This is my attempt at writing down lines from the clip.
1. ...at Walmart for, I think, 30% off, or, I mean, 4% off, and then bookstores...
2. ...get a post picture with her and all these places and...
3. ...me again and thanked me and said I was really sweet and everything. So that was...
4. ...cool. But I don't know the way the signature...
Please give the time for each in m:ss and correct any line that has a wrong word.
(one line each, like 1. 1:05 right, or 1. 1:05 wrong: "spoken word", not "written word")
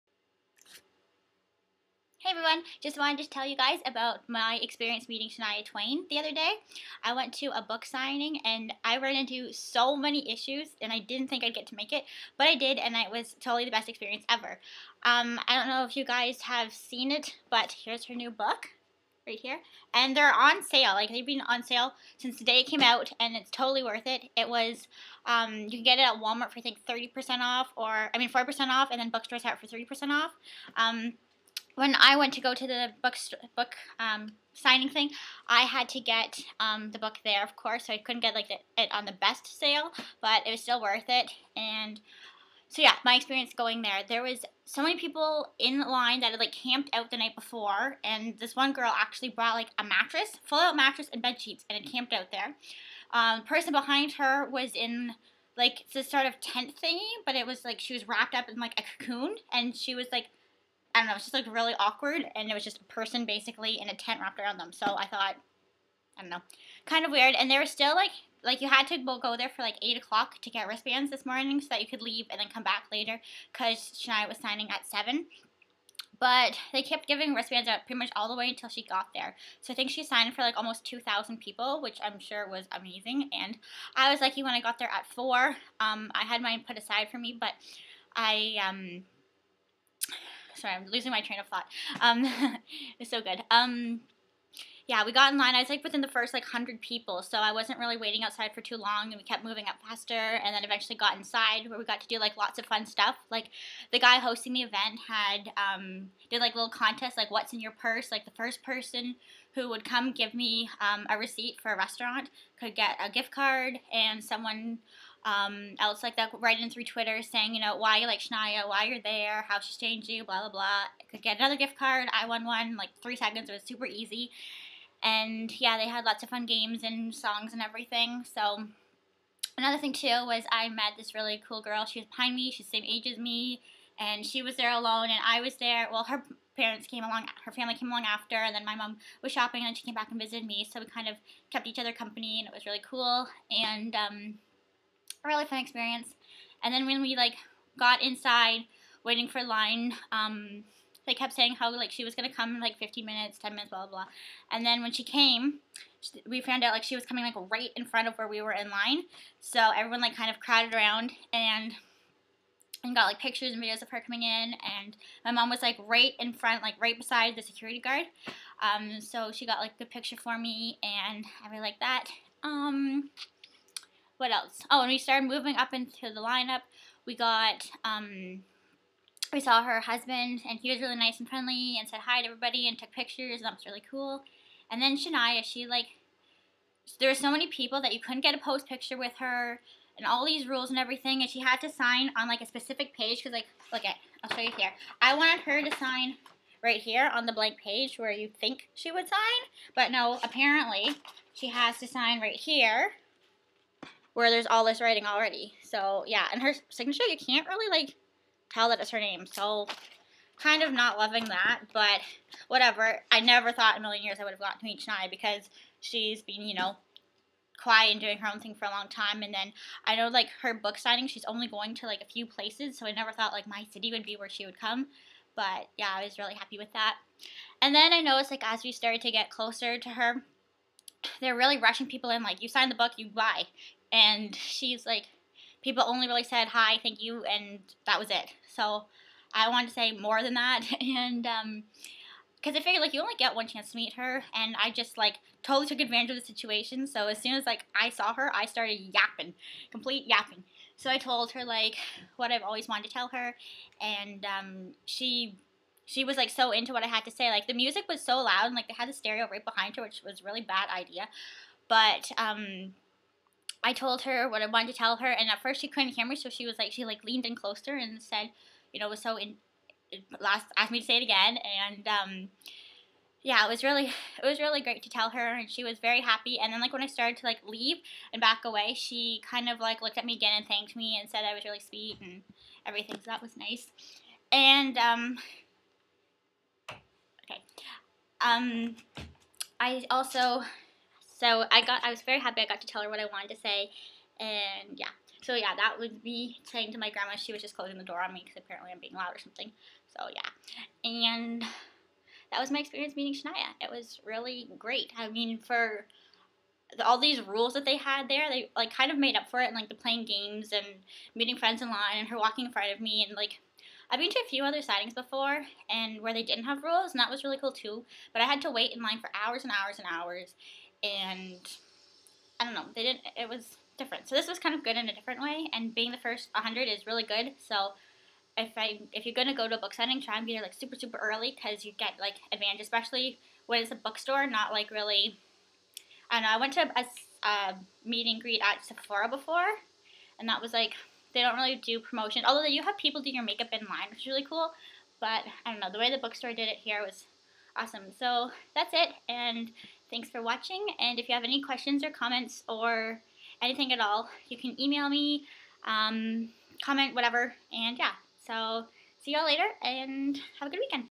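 1. 0:26 right
2. 3:08 wrong: "rules", not "places"
3. 4:40 right
4. 5:44 wrong: "bookstore", not "signature".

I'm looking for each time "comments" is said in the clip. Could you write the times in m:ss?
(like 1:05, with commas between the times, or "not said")
5:51, 5:56.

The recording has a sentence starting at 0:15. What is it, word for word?
Um, I don't know if you guys have seen it, but here's her new book right here.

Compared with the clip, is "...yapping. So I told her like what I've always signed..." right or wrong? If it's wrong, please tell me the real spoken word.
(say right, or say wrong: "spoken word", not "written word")
wrong: "wanted", not "signed".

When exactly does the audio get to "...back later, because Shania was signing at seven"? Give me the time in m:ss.
1:12.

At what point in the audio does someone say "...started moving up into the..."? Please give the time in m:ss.
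2:54.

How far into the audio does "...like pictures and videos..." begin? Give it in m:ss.
2:43.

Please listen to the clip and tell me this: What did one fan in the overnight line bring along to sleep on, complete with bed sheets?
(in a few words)
A mattress.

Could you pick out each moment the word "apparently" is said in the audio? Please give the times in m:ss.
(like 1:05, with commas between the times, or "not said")
3:20, 4:58.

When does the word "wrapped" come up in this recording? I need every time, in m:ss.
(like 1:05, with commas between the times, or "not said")
0:58, 1:04.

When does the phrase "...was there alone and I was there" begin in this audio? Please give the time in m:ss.
2:14.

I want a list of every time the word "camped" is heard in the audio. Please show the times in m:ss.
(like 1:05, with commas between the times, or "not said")
0:46, 0:51.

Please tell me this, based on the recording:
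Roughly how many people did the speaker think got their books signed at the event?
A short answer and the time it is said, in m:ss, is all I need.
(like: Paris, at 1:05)
2,000, at 1:20.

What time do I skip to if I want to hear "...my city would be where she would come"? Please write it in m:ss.
3:43.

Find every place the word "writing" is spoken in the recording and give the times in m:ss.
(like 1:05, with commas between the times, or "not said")
1:56, 3:24.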